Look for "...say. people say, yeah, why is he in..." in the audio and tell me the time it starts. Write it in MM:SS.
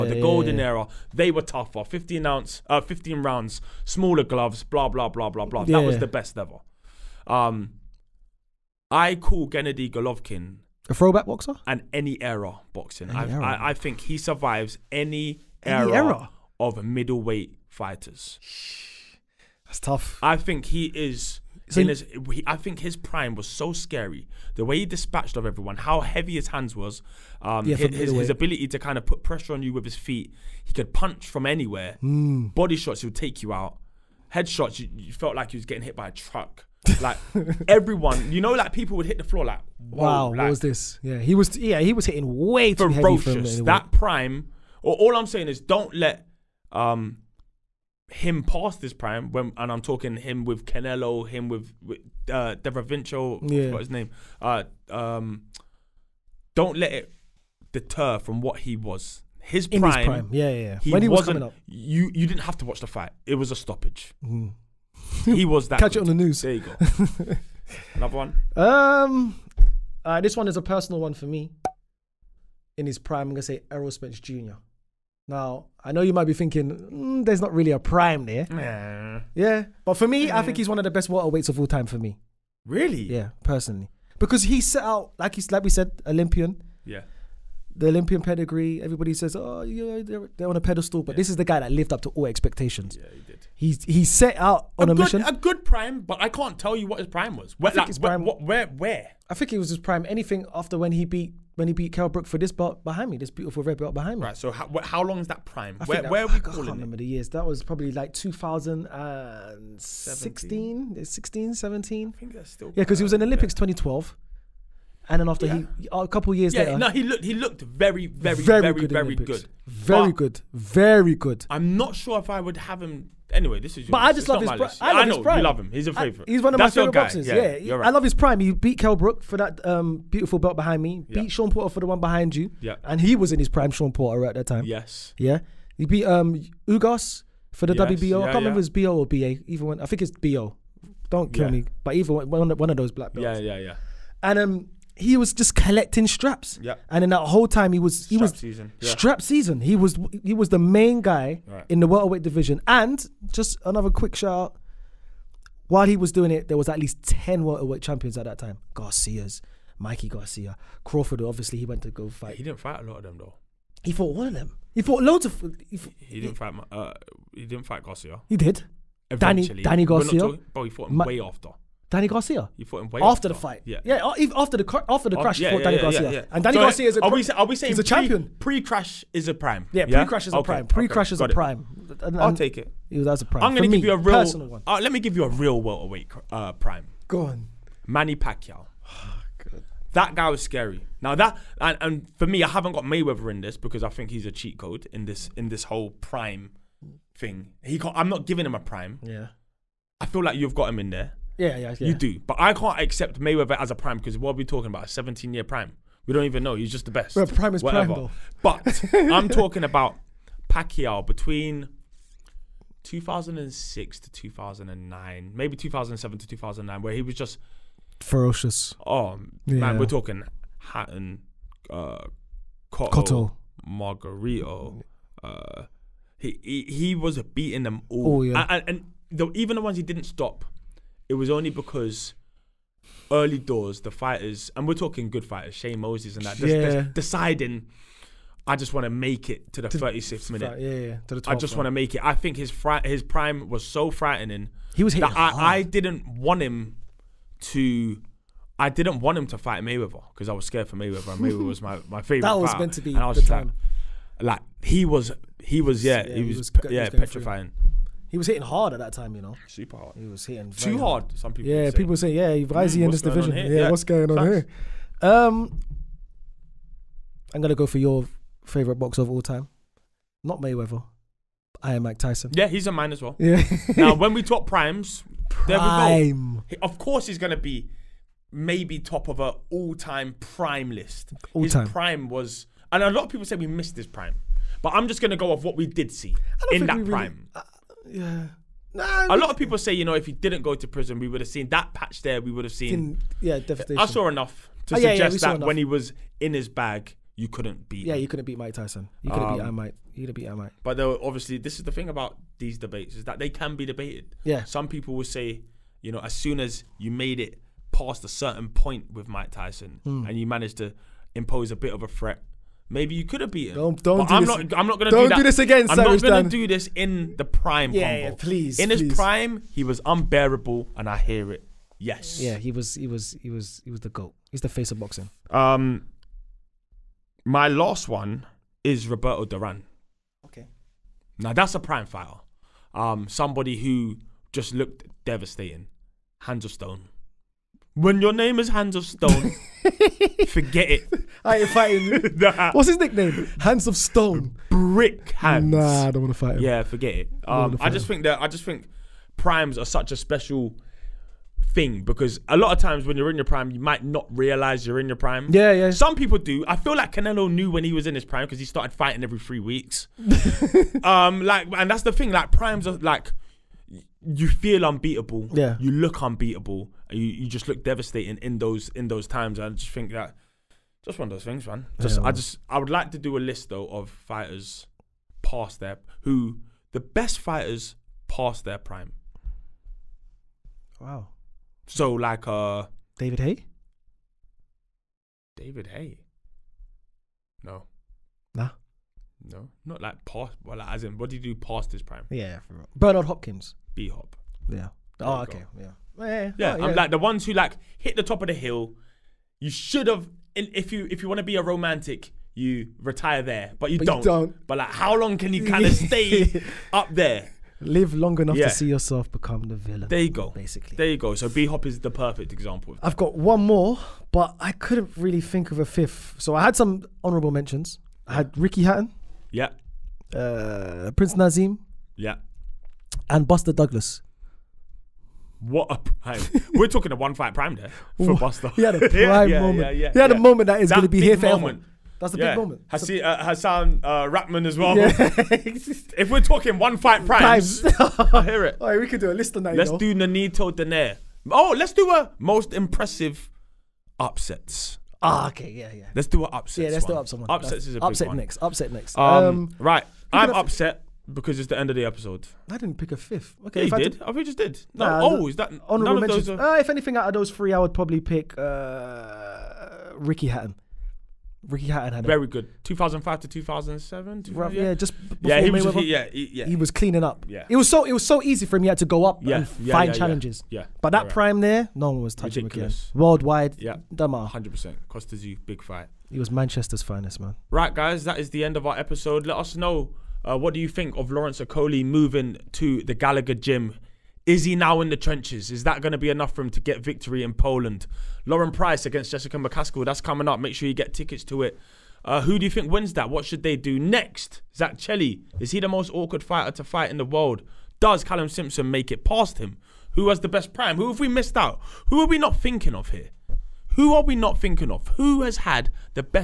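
04:21.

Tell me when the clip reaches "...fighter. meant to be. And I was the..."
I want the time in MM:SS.
04:12.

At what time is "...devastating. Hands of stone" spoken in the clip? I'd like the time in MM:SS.
05:35.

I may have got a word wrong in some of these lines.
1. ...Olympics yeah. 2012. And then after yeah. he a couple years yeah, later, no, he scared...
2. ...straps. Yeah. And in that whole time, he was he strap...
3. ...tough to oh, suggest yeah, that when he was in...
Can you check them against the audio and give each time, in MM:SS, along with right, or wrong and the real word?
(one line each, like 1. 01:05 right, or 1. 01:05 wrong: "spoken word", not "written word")
1. 01:53 wrong: "looked", not "scared"
2. 02:26 right
3. 04:54 wrong: "enough", not "tough".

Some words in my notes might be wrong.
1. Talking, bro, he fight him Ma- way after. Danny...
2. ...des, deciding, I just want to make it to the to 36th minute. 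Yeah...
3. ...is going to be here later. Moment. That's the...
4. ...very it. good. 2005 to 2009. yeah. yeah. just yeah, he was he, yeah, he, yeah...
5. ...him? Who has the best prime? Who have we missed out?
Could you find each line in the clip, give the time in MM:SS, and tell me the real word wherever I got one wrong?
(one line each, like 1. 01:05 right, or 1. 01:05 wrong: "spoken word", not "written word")
1. 02:50 wrong: "fought", not "fight"
2. 03:56 right
3. 07:10 wrong: "forever", not "later"
4. 07:42 wrong: "2007", not "2009"
5. 08:19 right.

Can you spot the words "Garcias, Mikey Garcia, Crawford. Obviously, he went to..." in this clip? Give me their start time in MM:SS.
02:38.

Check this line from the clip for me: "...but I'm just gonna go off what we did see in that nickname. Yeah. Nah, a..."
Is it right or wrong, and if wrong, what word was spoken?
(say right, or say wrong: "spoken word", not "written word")
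wrong: "prime", not "nickname".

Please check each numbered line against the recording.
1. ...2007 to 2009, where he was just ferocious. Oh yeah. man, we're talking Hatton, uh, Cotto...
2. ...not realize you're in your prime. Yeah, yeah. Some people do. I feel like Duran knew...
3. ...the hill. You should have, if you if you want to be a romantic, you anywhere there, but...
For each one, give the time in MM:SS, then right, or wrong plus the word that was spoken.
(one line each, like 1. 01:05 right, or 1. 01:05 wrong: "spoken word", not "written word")
1. 03:35 right
2. 05:53 wrong: "Canelo", not "Duran"
3. 06:38 wrong: "retire", not "anywhere".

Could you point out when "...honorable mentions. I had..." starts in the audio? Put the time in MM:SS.
06:57.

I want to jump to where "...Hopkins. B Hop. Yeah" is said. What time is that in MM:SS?
06:33.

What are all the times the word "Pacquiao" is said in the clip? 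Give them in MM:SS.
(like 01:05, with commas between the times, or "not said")
03:08, 03:30.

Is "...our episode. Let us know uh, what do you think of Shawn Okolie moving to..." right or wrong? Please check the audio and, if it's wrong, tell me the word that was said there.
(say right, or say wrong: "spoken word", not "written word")
wrong: "Lawrence", not "Shawn".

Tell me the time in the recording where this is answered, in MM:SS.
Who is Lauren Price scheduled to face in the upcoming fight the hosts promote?
08:09.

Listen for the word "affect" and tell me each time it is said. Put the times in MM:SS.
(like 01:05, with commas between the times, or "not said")
not said.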